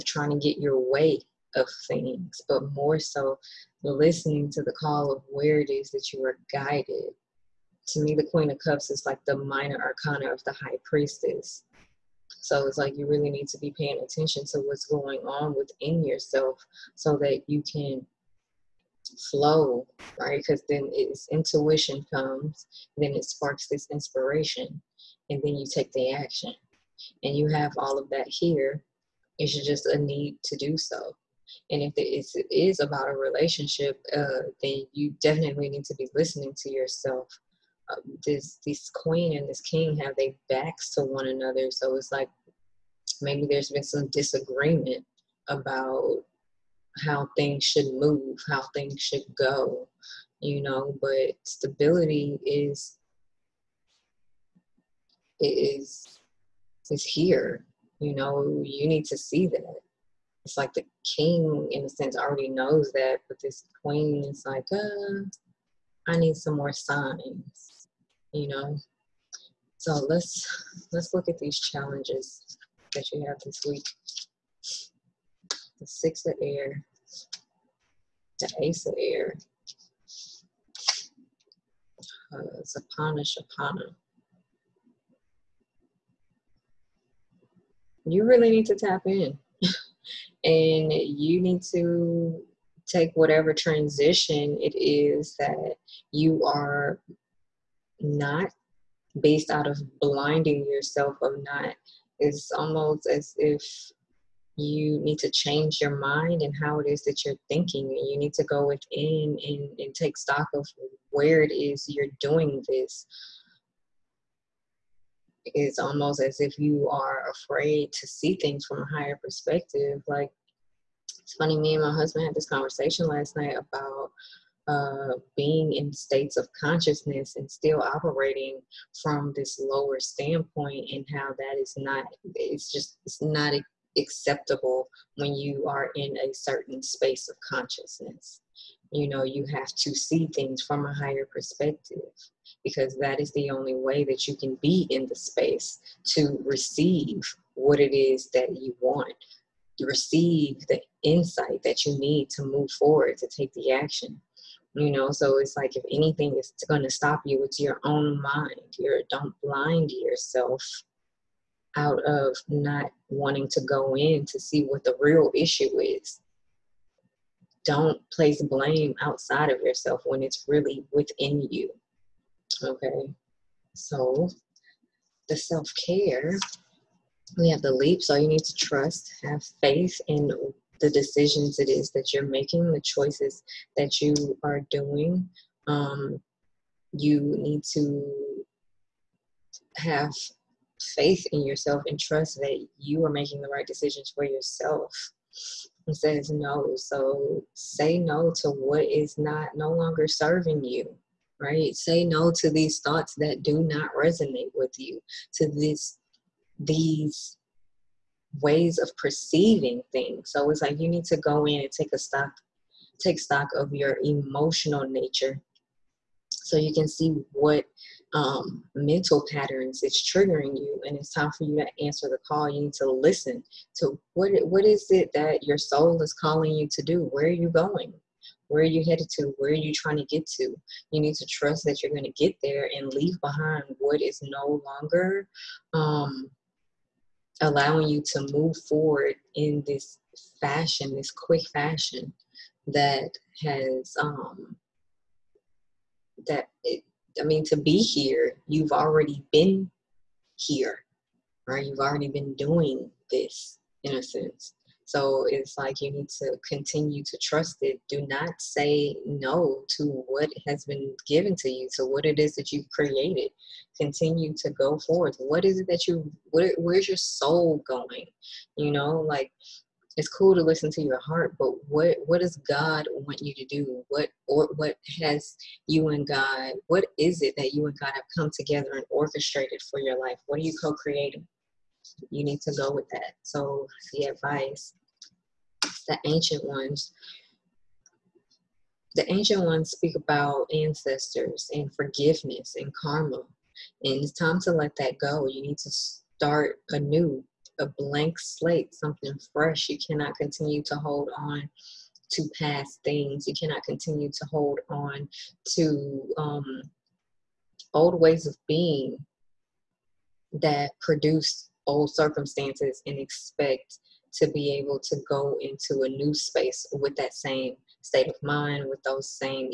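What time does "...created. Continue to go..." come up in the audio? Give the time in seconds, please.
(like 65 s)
262 s.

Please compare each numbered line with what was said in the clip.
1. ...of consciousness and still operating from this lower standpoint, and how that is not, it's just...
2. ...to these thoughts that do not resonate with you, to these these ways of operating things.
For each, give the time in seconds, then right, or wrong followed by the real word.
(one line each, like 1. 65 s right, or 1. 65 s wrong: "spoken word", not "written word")
1. 126 s right
2. 202 s wrong: "perceiving", not "operating".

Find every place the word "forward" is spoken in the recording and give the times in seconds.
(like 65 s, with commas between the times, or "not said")
152 s, 238 s.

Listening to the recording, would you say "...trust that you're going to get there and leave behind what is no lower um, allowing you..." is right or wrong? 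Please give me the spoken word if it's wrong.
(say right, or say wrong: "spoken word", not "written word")
wrong: "longer", not "lower".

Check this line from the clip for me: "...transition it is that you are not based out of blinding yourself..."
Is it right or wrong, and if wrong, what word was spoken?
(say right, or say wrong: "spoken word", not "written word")
right.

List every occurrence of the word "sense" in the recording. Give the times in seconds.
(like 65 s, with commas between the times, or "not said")
61 s, 254 s.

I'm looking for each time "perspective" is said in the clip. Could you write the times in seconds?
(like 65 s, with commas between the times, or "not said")
119 s, 141 s.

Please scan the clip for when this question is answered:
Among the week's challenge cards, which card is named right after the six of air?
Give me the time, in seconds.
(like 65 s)
78 s.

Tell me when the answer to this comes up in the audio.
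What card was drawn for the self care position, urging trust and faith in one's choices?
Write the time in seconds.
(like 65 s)
177 s.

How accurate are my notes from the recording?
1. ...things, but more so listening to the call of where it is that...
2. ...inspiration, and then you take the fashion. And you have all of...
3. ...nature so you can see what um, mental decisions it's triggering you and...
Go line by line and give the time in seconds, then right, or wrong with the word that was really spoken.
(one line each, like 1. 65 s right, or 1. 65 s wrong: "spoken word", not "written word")
1. 1 s right
2. 23 s wrong: "action", not "fashion"
3. 214 s wrong: "patterns", not "decisions".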